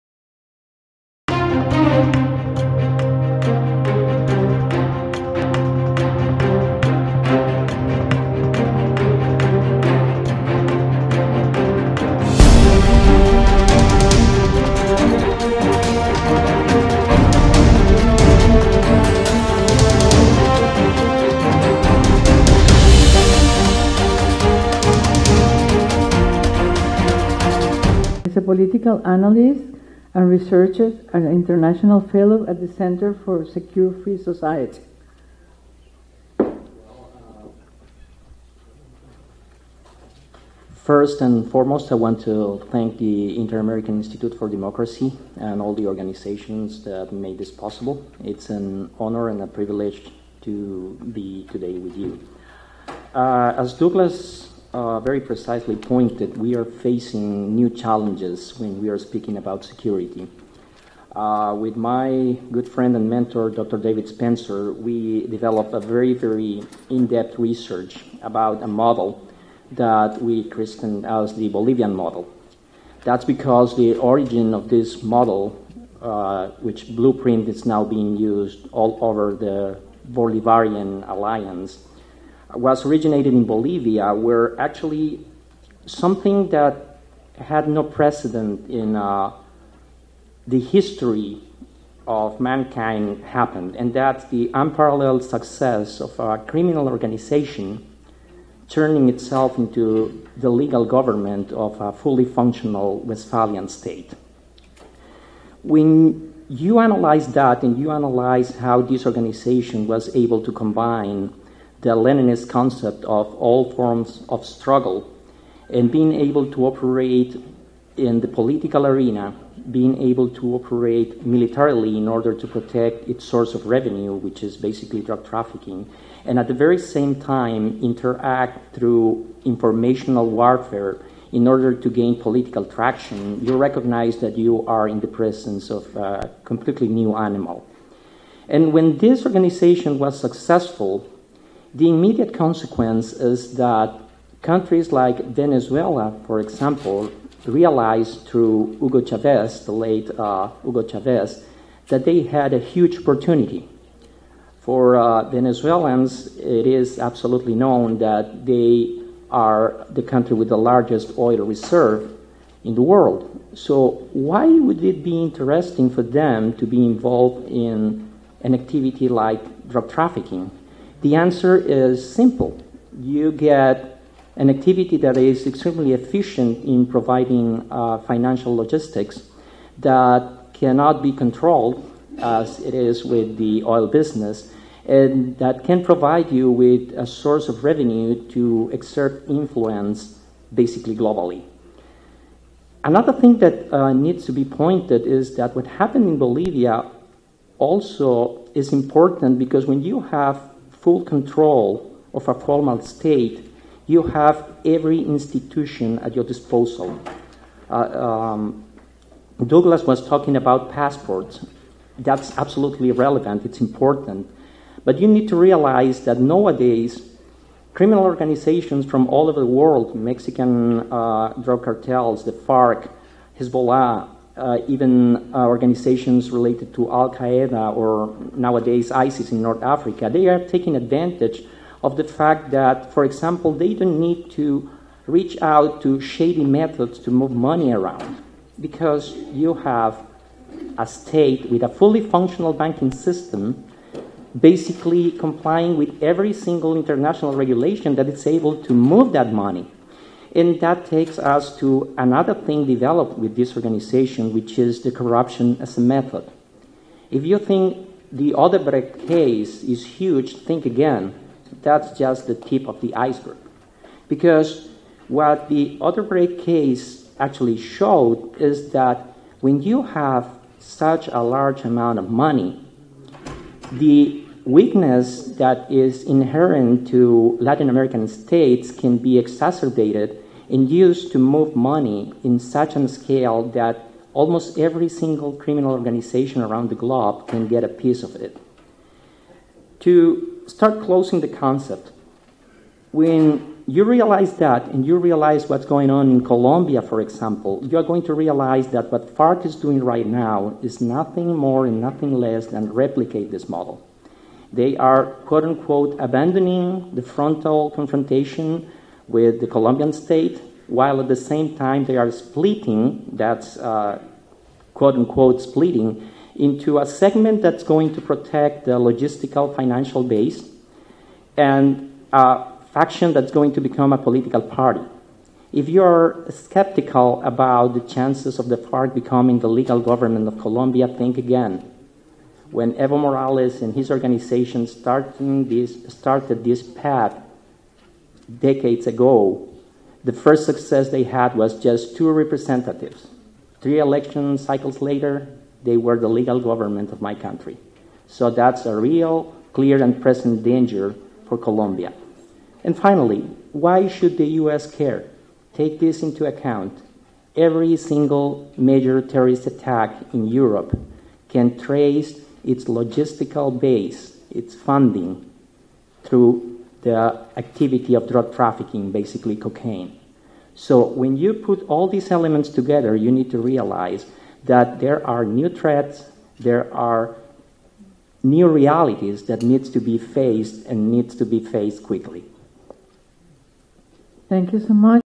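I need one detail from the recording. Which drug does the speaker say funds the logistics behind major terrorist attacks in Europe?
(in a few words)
cocaine.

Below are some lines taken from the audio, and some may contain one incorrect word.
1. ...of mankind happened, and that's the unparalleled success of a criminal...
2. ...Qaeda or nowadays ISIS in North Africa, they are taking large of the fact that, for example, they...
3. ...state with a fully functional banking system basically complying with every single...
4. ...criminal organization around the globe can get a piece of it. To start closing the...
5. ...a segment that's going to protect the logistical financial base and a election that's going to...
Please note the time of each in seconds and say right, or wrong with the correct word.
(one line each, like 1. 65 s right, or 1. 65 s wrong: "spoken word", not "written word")
1. 92 s right
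2. 227 s wrong: "advantage", not "large"
3. 240 s right
4. 285 s right
5. 316 s wrong: "faction", not "election".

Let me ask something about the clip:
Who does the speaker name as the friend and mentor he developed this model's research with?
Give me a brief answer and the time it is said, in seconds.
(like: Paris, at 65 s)
Dr. David Spencer, at 63 s.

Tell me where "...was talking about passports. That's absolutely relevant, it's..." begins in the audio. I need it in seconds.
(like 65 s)
209 s.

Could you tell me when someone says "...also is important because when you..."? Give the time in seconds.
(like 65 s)
197 s.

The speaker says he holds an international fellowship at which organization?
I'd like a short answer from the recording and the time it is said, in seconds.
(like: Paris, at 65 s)
Center for Secure Free Society, at 32 s.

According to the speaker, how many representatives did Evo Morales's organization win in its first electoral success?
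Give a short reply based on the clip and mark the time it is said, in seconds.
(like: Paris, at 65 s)
2, at 341 s.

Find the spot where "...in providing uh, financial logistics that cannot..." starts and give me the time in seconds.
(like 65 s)
176 s.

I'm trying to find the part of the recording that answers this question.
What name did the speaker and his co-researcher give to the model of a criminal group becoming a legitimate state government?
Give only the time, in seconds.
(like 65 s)
71 s.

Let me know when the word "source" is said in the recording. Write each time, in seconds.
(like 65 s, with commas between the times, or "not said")
123 s, 187 s.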